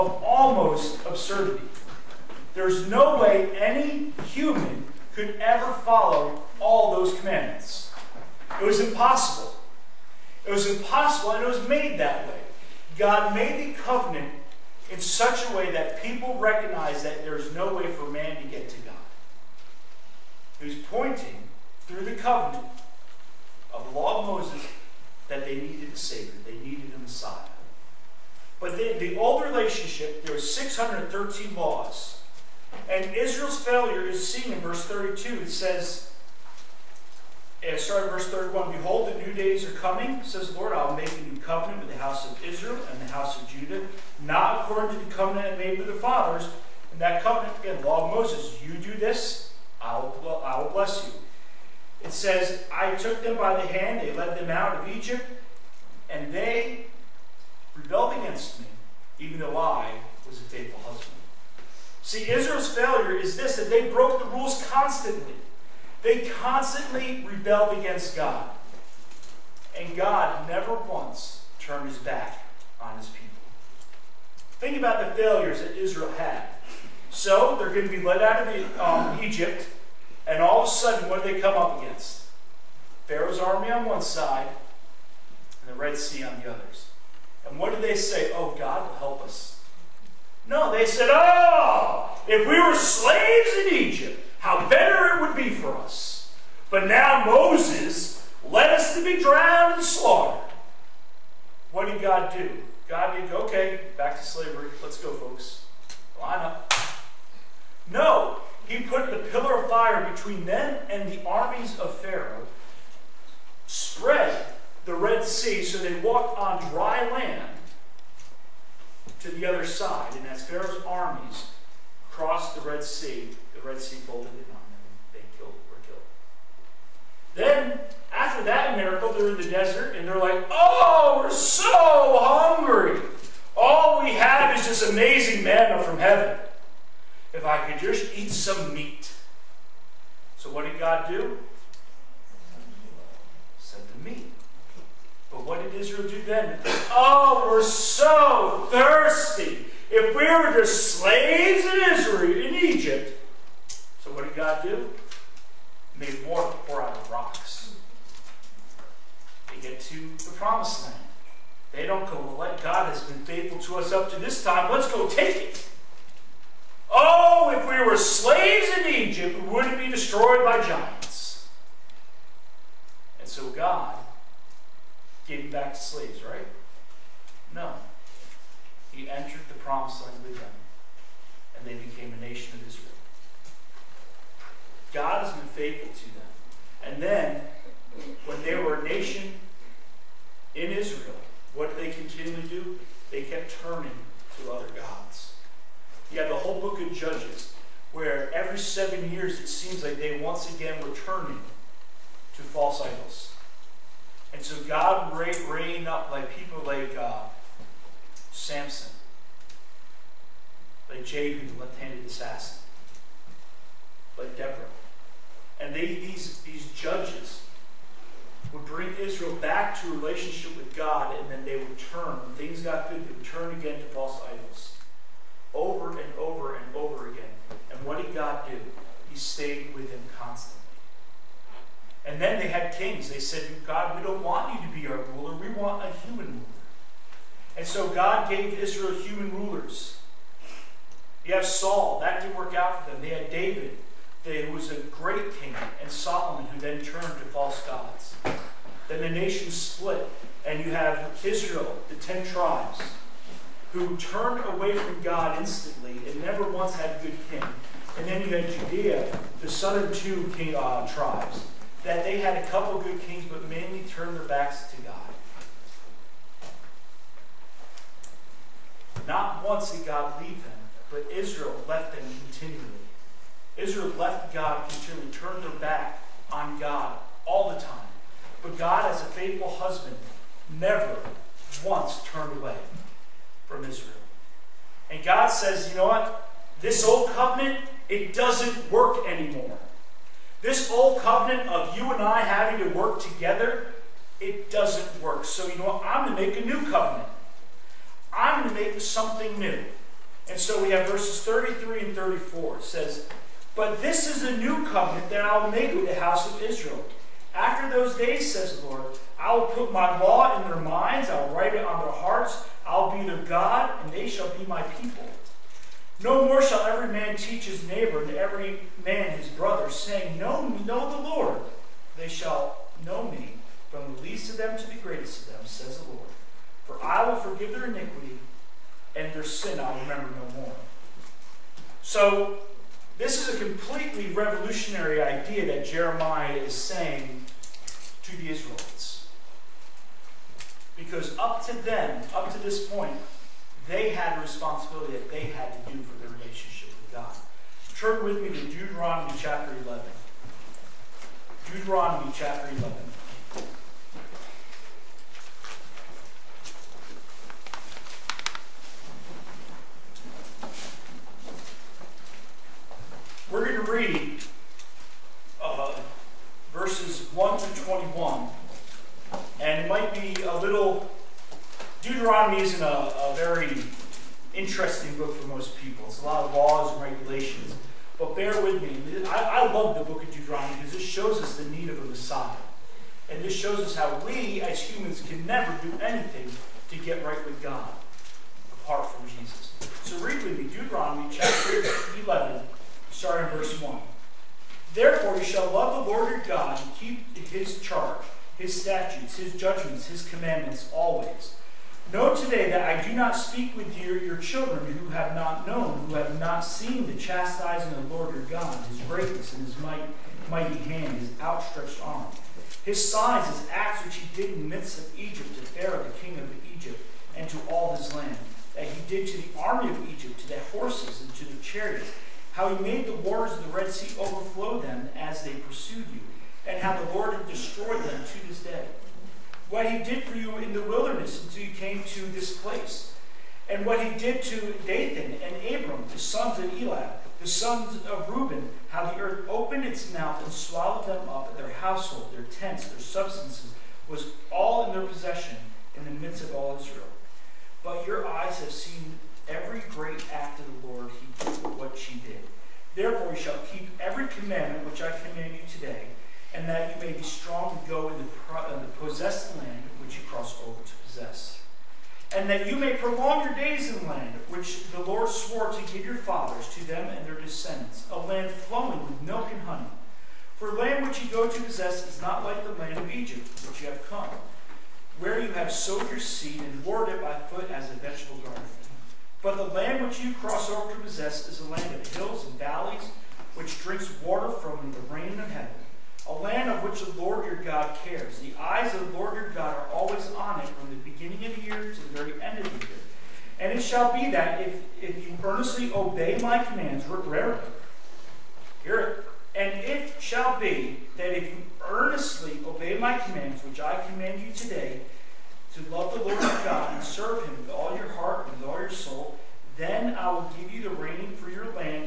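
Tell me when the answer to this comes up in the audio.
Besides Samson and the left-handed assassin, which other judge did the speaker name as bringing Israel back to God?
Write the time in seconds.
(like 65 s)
214 s.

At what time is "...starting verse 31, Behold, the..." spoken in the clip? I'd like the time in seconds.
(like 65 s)
37 s.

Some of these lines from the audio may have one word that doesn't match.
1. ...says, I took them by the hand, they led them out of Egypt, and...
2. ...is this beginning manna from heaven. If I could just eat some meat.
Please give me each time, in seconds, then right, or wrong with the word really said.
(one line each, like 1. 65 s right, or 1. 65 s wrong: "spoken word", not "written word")
1. 52 s right
2. 134 s wrong: "amazing", not "beginning".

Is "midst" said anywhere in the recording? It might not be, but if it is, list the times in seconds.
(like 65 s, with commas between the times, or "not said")
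414 s, 445 s.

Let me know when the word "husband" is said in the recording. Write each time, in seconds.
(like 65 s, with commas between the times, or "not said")
60 s, 279 s.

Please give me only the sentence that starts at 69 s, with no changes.
And God never once turned his back on his people.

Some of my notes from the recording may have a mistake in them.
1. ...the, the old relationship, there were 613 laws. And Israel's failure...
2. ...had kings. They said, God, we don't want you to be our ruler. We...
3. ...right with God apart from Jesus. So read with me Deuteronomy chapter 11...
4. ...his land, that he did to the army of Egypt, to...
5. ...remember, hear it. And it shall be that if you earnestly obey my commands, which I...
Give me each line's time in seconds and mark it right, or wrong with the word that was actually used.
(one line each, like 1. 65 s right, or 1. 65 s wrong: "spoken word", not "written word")
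1. 28 s right
2. 232 s right
3. 387 s right
4. 417 s right
5. 496 s right.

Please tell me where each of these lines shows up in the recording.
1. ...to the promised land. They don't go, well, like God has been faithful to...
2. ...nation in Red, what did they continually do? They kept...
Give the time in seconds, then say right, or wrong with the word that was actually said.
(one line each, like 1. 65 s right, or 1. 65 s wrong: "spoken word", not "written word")
1. 159 s right
2. 188 s wrong: "Israel", not "Red".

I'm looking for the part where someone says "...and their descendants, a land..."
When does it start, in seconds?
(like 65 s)
466 s.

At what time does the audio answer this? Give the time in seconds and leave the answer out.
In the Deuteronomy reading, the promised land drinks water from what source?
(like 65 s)
484 s.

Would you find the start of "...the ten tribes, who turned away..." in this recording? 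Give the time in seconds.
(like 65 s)
251 s.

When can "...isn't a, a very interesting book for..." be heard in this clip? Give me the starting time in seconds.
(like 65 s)
372 s.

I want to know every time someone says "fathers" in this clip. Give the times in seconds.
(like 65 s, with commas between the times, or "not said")
45 s, 465 s.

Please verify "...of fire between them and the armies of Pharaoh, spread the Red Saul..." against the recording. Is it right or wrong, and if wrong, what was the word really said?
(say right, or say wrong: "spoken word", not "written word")
wrong: "Sea", not "Saul".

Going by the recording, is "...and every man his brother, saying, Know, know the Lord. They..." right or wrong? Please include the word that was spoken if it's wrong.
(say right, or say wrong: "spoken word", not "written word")
right.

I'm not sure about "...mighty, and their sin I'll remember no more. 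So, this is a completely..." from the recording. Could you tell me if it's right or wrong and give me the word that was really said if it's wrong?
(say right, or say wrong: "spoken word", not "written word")
wrong: "iniquity", not "mighty".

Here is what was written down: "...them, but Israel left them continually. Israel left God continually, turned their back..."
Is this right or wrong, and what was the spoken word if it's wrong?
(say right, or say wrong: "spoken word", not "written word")
right.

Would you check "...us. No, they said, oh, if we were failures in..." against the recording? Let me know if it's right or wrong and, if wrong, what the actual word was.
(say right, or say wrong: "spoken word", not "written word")
wrong: "slaves", not "failures".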